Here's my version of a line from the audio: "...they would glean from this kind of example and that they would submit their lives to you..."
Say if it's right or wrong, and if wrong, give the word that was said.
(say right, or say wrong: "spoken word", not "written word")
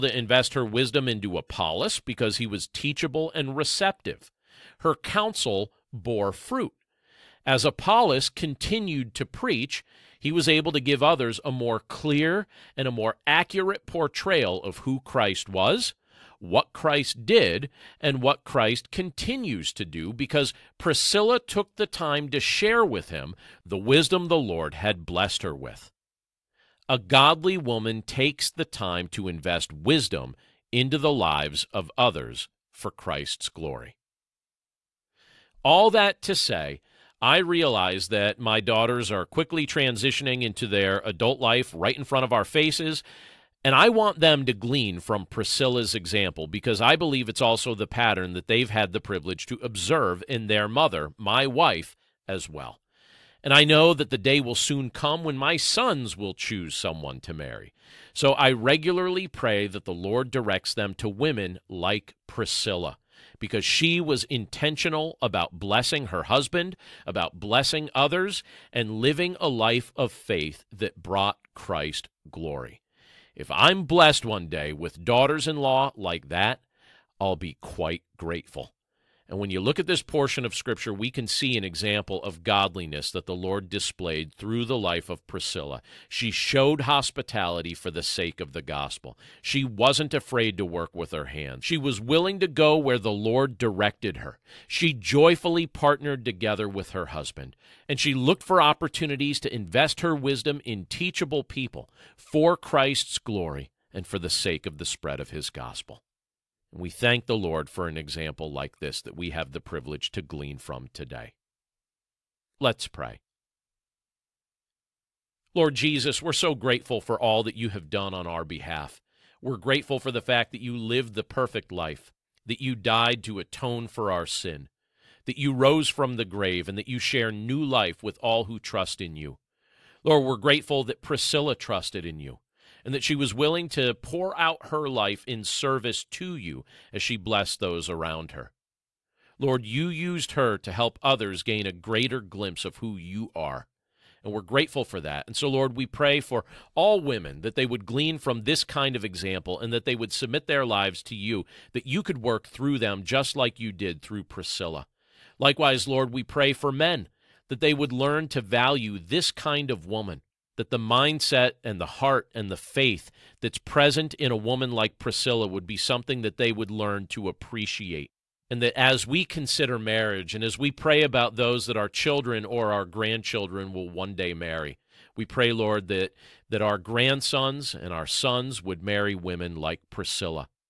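right.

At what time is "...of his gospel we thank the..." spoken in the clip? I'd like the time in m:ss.
1:45.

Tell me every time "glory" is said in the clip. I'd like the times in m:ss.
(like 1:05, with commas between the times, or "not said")
0:33, 1:12, 1:43.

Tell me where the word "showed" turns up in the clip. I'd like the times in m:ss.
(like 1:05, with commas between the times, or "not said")
1:26.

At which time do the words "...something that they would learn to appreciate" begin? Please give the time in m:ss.
2:45.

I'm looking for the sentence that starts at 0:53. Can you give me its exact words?
And I know that the day will soon come when my sons will choose someone to marry.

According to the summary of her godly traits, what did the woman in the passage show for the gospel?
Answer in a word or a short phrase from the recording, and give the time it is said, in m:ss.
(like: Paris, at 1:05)
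Hospitality, at 1:26.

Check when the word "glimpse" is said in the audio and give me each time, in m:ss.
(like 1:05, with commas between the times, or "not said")
2:22.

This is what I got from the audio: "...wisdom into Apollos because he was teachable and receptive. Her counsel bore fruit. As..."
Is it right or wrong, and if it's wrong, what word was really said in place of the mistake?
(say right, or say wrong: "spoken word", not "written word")
right.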